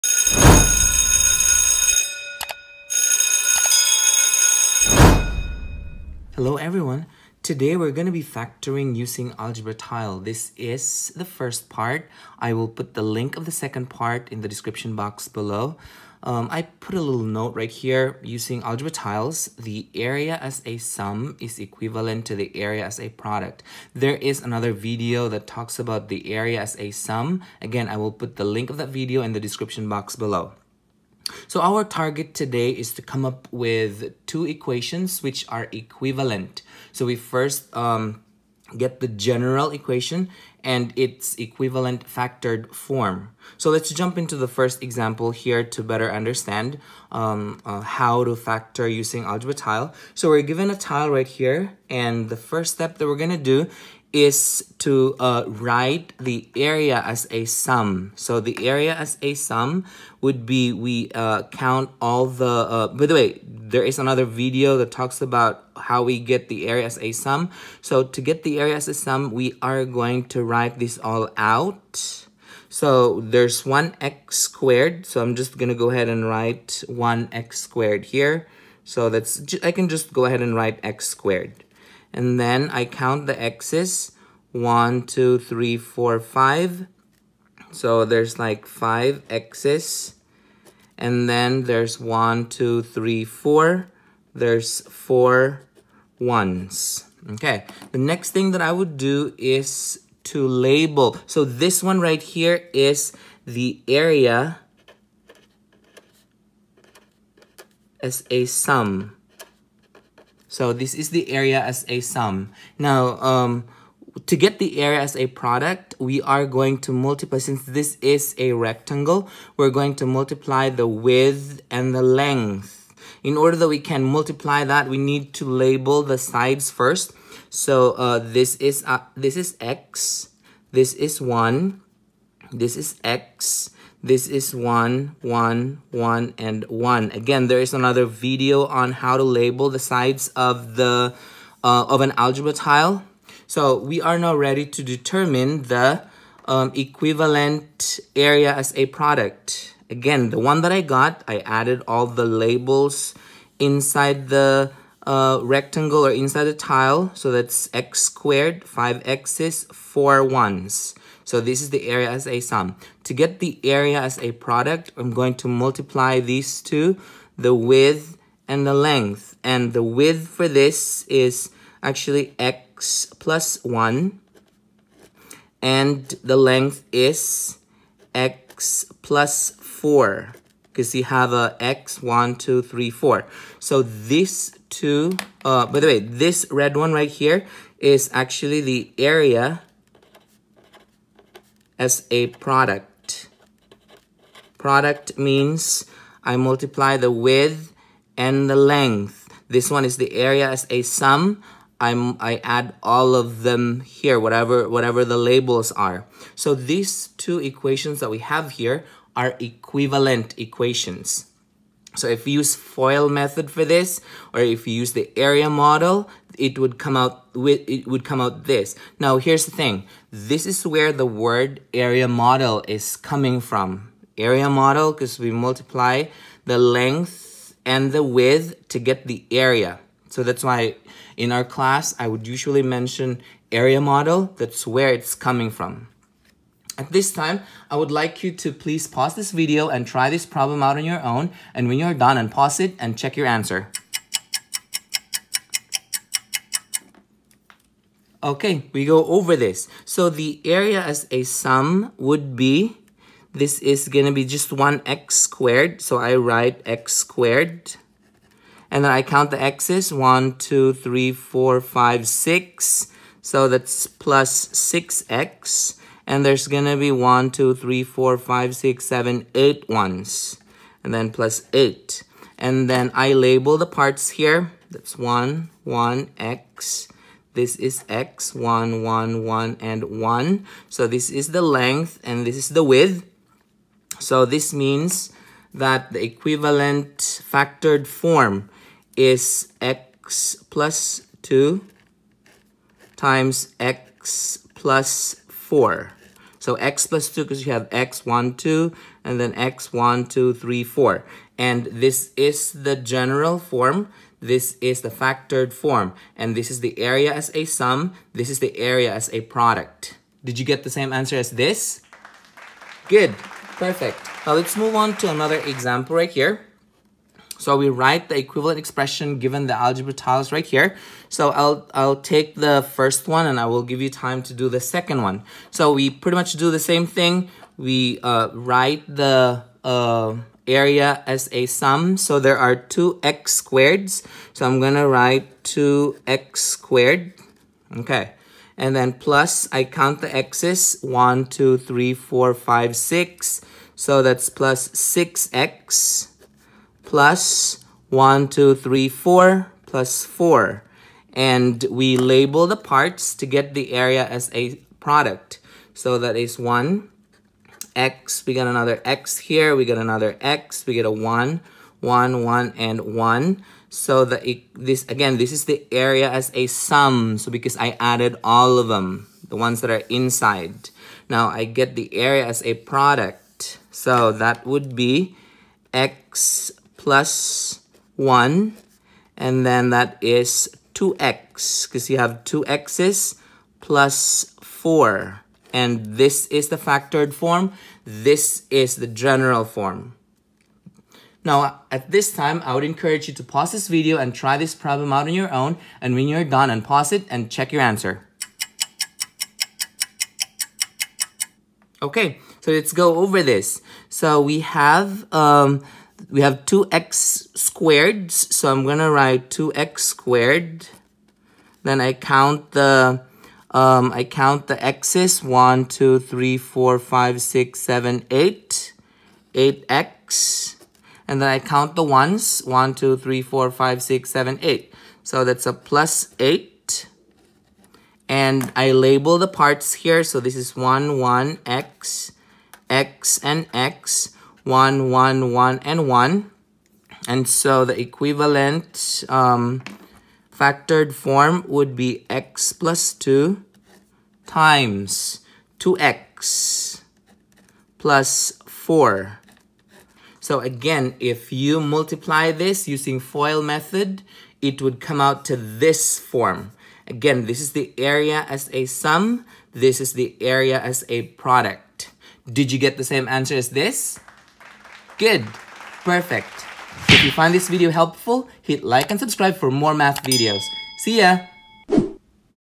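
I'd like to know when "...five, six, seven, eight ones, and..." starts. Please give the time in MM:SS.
04:28.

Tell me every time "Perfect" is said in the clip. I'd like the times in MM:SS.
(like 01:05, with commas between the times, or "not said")
05:13, 07:45.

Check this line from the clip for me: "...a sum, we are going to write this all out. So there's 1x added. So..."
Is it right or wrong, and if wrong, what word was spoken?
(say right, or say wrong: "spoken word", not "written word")
wrong: "squared", not "added".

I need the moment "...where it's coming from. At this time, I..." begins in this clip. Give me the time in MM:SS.
03:54.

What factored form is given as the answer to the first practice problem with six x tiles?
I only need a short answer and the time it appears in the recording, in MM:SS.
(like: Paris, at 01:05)
(x + 2)(x + 4), at 04:49.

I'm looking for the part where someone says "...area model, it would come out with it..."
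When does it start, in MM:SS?
03:35.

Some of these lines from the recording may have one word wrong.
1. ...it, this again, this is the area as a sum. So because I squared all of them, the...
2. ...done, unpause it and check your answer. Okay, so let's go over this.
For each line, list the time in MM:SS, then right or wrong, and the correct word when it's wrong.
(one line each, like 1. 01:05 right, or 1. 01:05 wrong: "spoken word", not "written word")
1. 06:04 wrong: "added", not "squared"
2. 06:36 right.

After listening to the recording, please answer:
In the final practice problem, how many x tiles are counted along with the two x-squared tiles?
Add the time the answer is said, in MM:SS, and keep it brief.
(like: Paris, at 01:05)
8, at 06:59.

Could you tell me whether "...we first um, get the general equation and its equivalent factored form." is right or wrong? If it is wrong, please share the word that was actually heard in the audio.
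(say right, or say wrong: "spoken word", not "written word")
right.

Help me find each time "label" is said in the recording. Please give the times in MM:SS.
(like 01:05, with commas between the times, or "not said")
01:40, 02:05, 02:19, 02:32, 03:25, 04:33, 05:51, 07:08.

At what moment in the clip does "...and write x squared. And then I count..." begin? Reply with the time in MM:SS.
01:20.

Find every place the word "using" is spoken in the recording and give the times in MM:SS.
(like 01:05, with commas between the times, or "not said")
00:08, 00:18, 00:48, 07:32.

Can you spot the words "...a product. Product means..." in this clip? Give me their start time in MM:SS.
03:12.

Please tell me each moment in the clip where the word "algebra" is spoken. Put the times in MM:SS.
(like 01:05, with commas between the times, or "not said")
00:09, 00:18, 00:49, 02:22, 05:19.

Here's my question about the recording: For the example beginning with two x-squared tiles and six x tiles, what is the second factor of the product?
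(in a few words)
2x + 4.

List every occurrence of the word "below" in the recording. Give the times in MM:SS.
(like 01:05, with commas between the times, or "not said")
00:15, 00:30.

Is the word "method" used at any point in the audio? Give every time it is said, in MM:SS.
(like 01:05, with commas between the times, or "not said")
03:33, 07:33.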